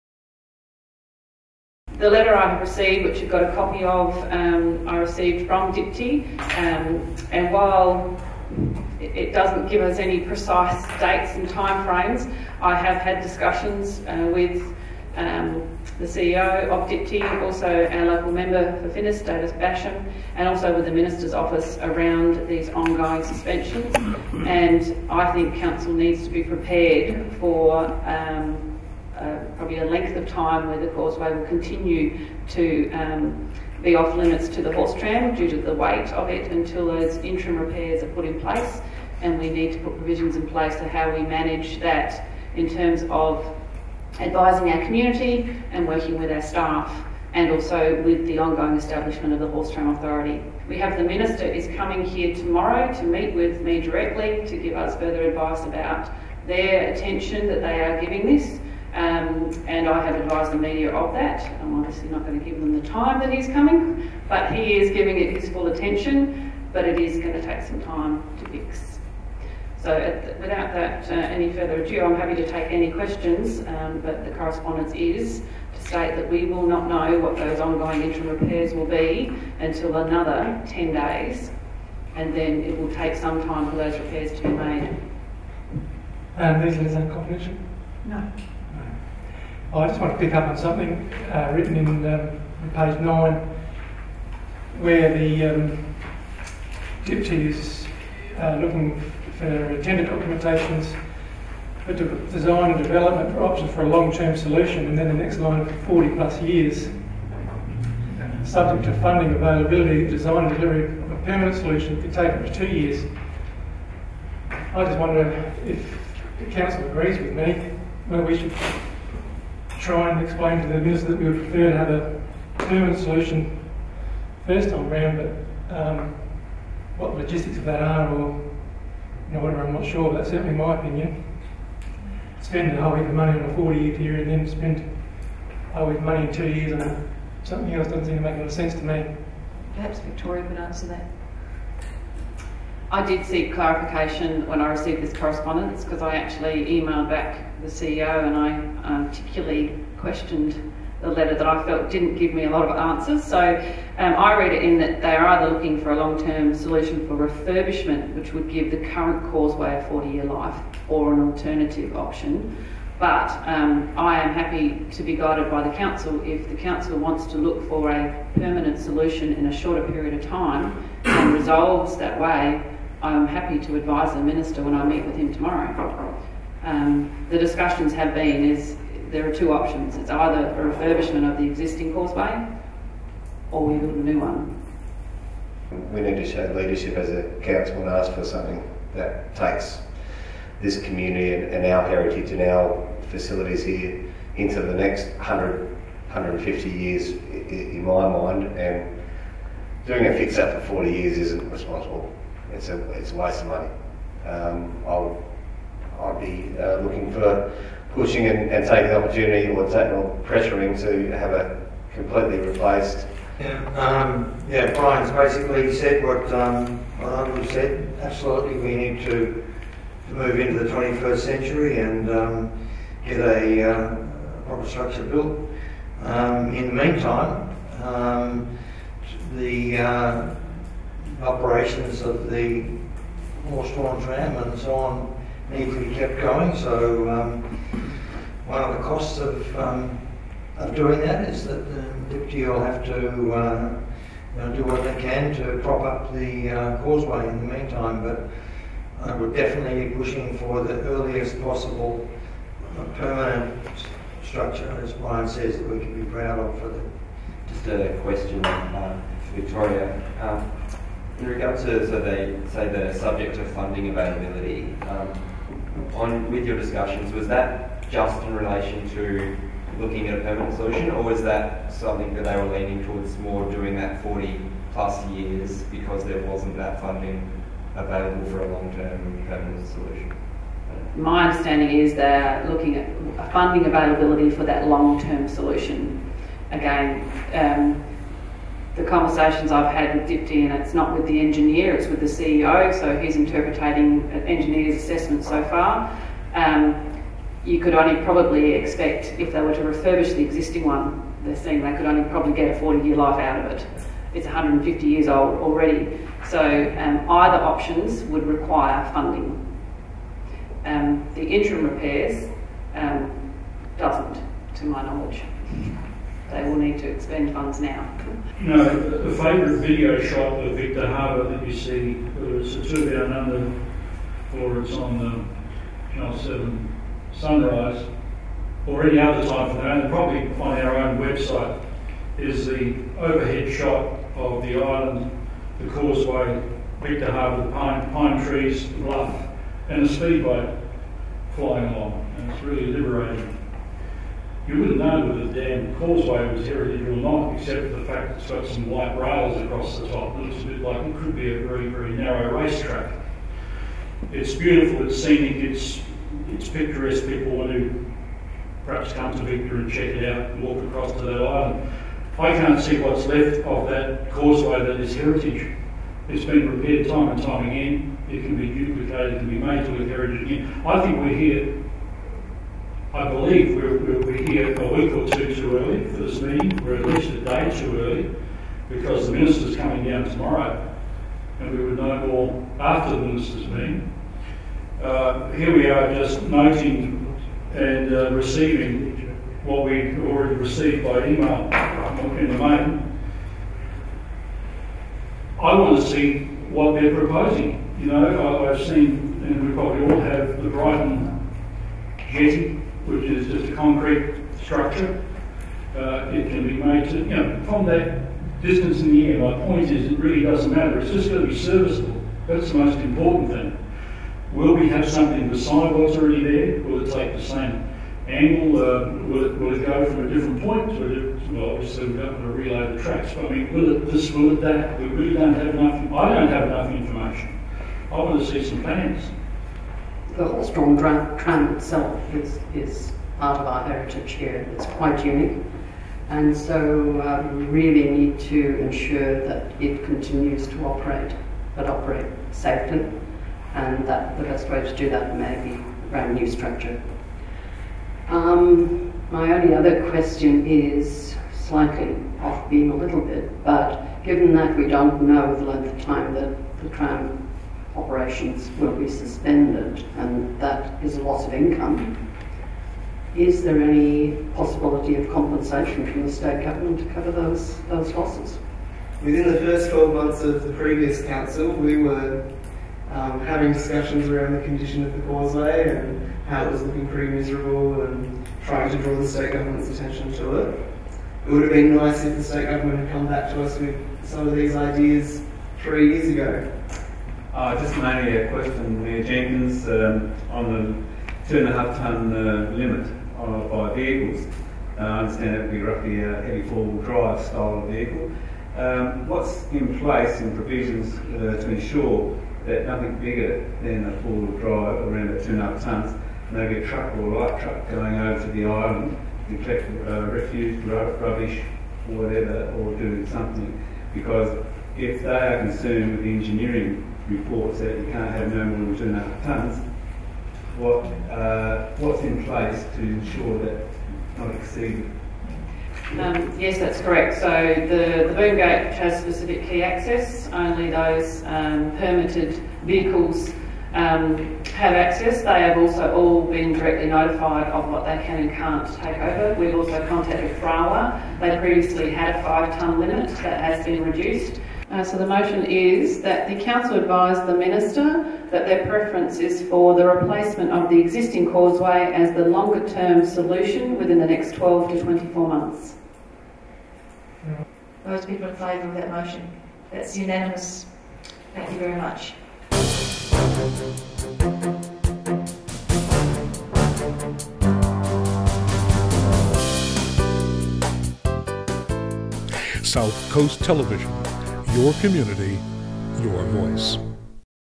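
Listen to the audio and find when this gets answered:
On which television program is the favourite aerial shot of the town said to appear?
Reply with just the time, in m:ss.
5:27.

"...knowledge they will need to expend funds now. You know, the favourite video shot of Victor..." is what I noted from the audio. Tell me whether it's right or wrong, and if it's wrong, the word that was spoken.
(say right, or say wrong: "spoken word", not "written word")
right.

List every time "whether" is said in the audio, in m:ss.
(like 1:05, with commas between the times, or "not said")
5:21.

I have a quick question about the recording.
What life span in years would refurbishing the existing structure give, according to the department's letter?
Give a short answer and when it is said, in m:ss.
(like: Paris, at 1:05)
40, at 2:39.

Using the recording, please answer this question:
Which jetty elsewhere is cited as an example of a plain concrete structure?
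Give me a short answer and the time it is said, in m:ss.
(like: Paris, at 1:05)
Brighton jetty, at 6:40.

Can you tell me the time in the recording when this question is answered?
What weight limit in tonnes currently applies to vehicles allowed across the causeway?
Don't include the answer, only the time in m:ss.
8:11.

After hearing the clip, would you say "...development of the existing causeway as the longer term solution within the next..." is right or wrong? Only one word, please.
wrong.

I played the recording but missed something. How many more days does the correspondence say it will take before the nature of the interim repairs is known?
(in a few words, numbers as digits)
10.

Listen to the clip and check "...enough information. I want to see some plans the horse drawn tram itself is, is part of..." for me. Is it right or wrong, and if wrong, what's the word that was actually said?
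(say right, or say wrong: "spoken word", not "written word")
right.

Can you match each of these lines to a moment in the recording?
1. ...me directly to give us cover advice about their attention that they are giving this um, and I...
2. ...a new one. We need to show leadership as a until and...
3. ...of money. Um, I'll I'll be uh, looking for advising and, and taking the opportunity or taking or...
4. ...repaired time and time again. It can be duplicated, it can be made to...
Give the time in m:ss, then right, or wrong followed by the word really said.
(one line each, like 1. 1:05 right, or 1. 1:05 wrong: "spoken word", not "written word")
1. 0:53 wrong: "further", not "cover"
2. 3:03 wrong: "council", not "until"
3. 3:23 wrong: "pushing", not "advising"
4. 6:06 right.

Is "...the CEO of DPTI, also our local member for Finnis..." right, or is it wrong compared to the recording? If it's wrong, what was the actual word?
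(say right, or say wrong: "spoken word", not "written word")
right.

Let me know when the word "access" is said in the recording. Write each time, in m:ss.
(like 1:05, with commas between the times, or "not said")
8:49, 8:54.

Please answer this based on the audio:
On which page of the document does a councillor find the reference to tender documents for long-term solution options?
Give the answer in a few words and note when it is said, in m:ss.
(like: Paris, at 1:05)
9, at 1:32.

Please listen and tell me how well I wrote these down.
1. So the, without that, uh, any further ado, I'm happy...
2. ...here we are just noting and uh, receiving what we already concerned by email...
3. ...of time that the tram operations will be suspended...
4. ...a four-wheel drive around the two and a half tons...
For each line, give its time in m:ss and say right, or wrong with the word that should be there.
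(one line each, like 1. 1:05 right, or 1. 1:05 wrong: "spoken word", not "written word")
1. 1:09 right
2. 6:25 wrong: "received", not "concerned"
3. 7:35 right
4. 8:23 right.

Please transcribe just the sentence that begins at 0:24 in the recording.
And I think Council needs to be prepared for.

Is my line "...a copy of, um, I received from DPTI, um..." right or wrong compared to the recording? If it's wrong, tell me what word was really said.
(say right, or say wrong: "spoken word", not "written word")
right.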